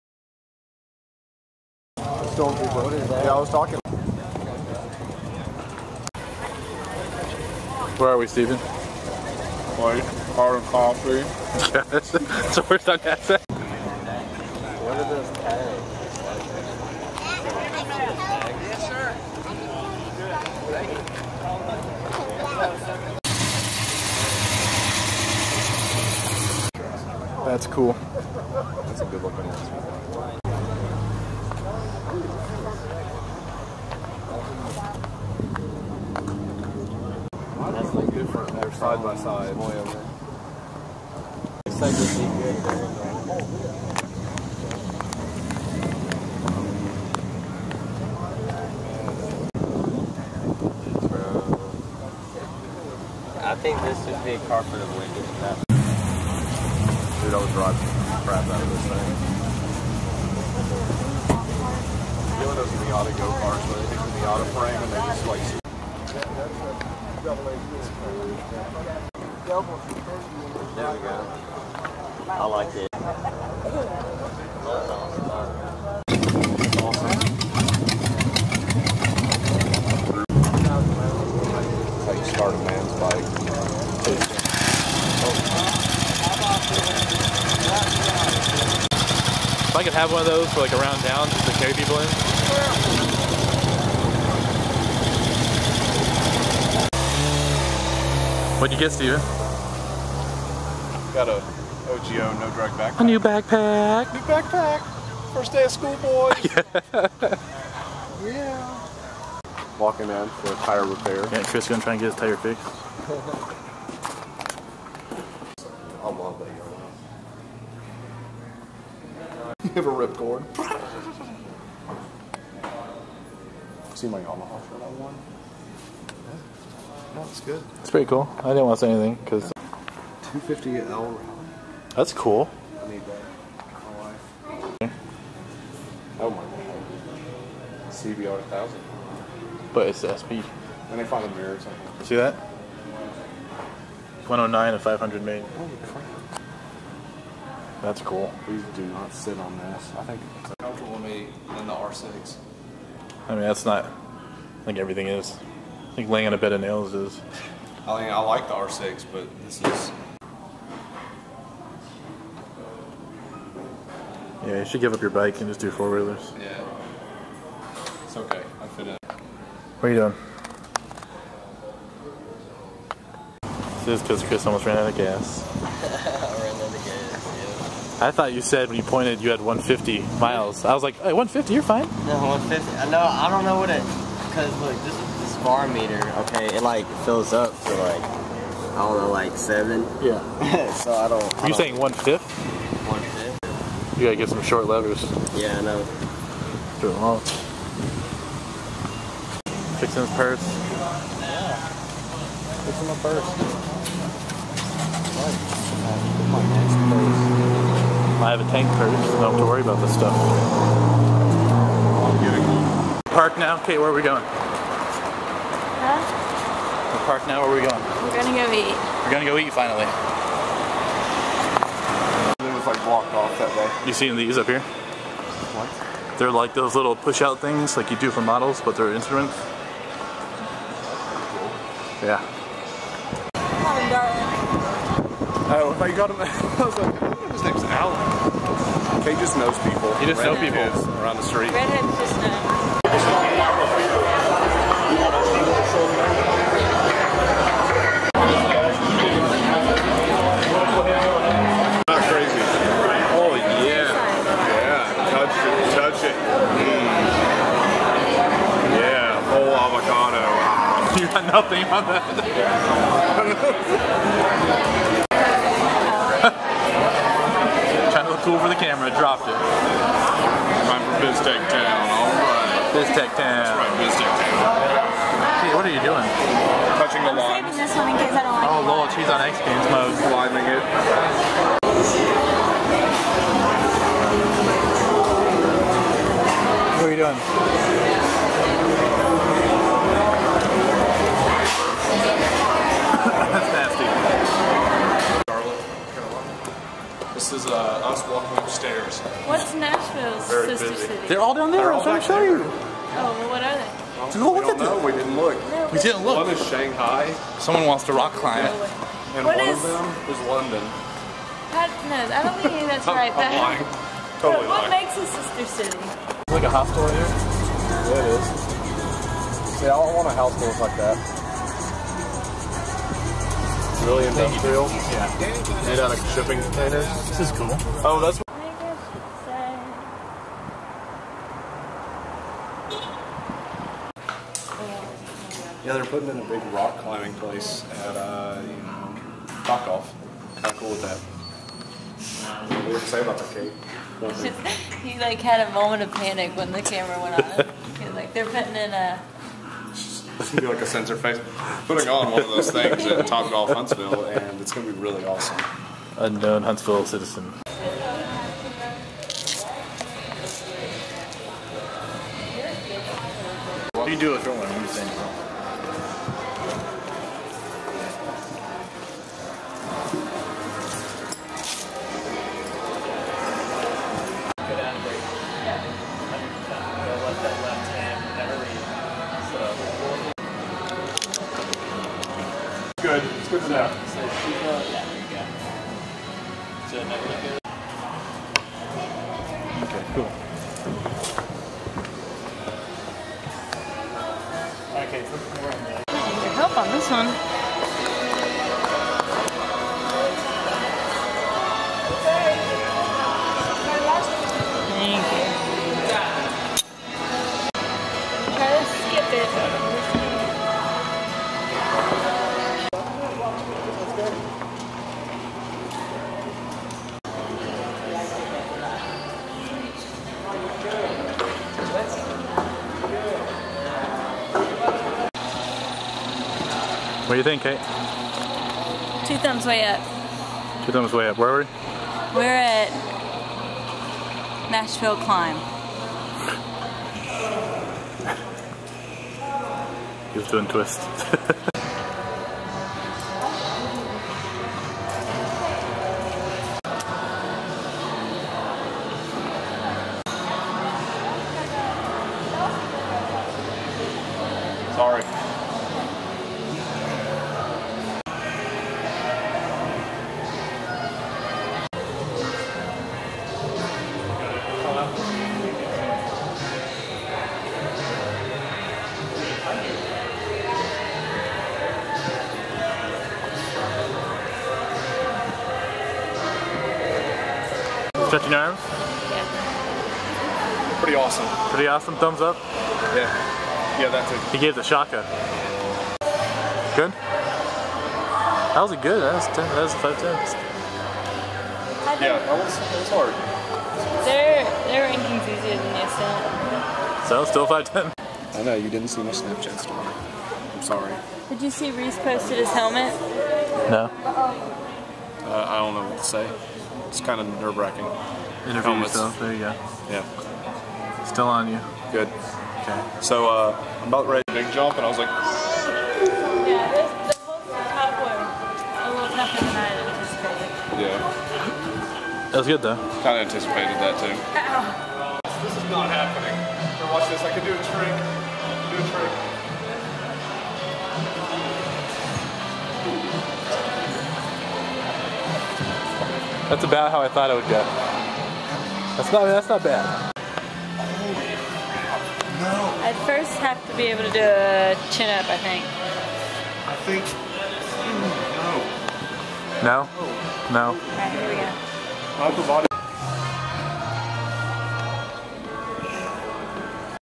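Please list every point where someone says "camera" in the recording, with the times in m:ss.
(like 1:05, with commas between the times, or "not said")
4:28, 5:46.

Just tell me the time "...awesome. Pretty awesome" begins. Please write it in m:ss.
8:00.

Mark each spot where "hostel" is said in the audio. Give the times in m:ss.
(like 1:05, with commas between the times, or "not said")
5:16.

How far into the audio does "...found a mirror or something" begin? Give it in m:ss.
2:21.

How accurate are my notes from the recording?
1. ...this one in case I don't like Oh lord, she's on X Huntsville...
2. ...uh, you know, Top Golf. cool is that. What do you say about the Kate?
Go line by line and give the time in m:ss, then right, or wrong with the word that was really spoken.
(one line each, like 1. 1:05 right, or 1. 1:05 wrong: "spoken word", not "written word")
1. 4:37 wrong: "Games", not "Huntsville"
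2. 5:37 right.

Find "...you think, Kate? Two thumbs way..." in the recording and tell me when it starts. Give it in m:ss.
7:07.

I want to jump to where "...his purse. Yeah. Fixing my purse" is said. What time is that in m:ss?
3:20.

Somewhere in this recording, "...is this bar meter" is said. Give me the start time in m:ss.
3:04.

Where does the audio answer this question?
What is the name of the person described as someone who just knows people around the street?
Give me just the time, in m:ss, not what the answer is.
3:57.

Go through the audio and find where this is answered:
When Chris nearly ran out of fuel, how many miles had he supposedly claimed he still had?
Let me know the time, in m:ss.
2:59.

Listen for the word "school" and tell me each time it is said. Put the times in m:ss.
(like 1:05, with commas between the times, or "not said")
1:45.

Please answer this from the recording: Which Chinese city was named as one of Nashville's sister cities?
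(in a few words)
Shanghai.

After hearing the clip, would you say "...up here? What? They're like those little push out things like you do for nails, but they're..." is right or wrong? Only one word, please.
wrong.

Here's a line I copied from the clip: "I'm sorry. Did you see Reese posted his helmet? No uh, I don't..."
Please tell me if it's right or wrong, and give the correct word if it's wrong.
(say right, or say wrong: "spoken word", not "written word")
right.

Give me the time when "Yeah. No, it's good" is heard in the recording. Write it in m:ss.
2:06.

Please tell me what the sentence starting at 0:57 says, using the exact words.
Dude, I was driving crap out of this thing.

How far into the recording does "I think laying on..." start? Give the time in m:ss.
2:35.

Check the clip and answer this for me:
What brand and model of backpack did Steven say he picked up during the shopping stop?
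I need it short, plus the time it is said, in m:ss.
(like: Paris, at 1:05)
OGIO No Drag, at 1:41.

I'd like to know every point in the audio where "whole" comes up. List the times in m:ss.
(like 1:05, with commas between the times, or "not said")
4:19, 8:37.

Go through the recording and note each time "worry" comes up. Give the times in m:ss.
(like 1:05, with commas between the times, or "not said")
3:29, 6:04.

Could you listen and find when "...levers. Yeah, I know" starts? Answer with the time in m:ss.
3:14.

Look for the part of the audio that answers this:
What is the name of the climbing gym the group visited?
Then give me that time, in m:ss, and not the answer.
7:14.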